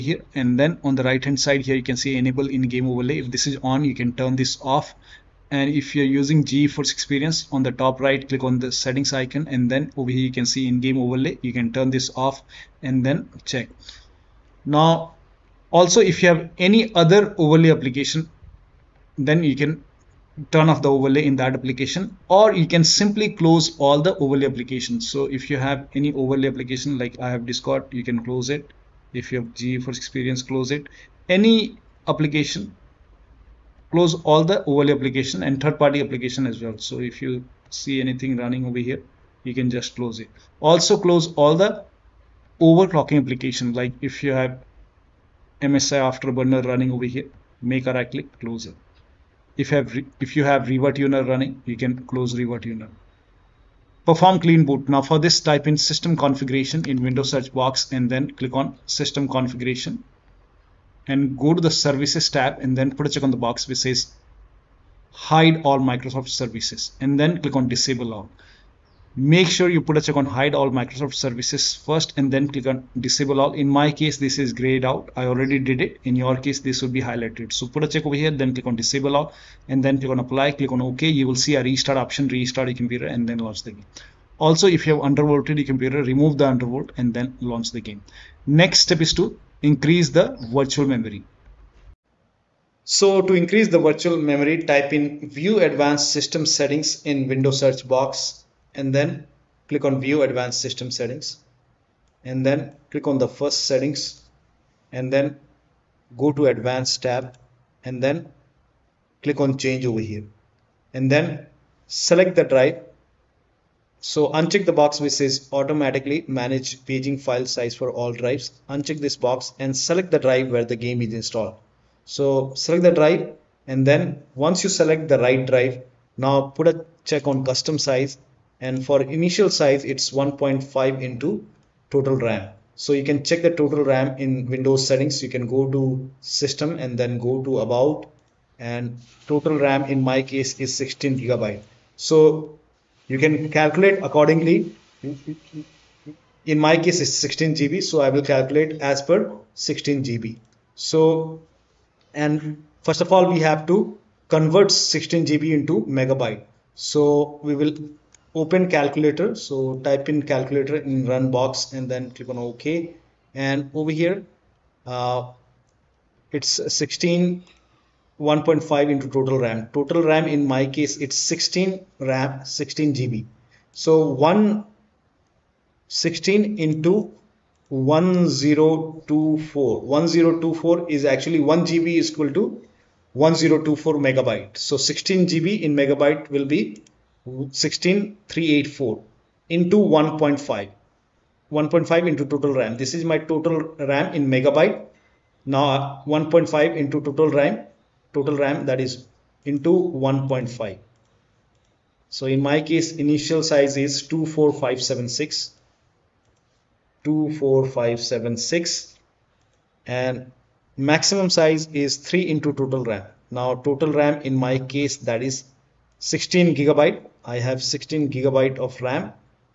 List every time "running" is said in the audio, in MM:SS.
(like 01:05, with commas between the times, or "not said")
00:38, 00:46, 00:51.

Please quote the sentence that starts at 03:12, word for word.
This is my total RAM in megabyte.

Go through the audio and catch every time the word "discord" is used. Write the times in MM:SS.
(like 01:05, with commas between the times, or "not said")
00:27.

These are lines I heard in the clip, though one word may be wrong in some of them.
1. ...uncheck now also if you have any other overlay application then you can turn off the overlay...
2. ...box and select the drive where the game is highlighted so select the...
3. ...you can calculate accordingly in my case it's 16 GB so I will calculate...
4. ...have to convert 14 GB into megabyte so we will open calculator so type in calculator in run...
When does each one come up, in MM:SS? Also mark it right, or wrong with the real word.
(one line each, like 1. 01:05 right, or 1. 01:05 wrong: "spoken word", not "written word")
1. 00:13 wrong: "check", not "uncheck"
2. 01:59 wrong: "installed", not "highlighted"
3. 02:23 right
4. 02:33 wrong: "16", not "14".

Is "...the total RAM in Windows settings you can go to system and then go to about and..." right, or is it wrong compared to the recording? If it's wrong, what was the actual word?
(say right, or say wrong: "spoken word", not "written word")
right.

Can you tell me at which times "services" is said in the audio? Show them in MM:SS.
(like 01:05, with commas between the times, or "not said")
01:01, 01:06, 01:11.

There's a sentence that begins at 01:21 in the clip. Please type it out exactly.
You will see a restart option, restart your computer and then launch the game.